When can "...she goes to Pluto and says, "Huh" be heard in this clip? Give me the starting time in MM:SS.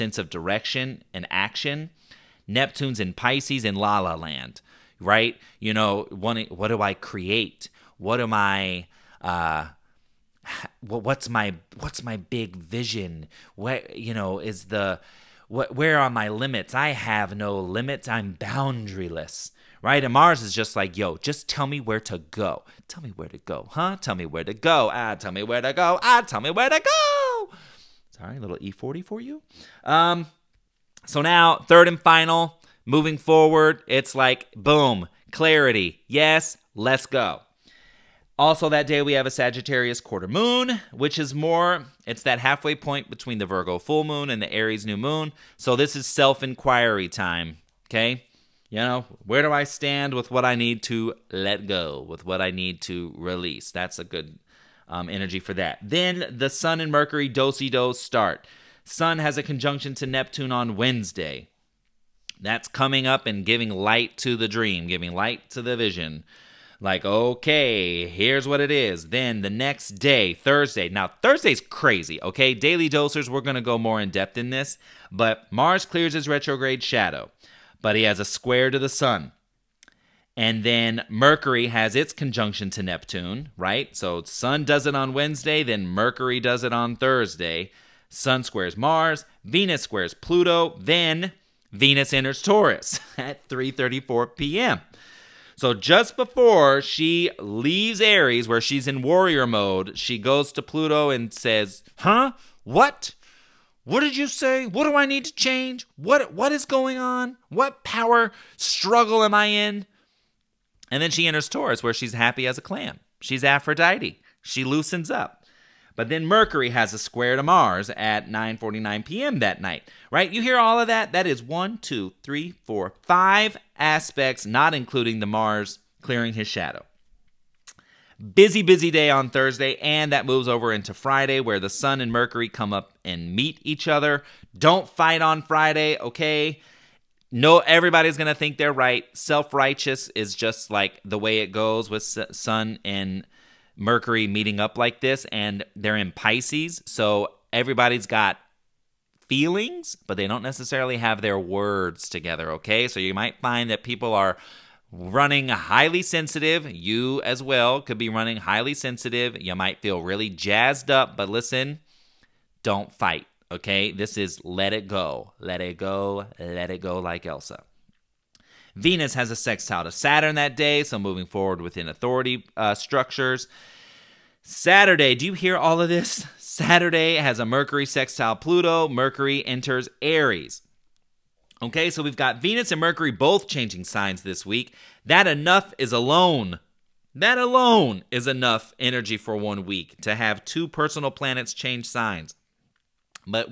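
01:39.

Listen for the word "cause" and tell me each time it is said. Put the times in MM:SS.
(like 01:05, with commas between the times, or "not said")
not said.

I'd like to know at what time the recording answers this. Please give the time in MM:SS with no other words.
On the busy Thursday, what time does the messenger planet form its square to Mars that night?
01:58.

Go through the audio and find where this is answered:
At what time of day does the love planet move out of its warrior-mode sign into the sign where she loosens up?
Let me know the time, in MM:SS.
01:33.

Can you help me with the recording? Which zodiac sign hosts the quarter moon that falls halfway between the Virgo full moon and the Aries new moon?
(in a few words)
Sagittarius.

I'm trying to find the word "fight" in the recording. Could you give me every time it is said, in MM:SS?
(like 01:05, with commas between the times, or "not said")
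02:14, 02:42.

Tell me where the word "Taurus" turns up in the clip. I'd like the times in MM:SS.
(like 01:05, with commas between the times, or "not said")
01:32, 01:51.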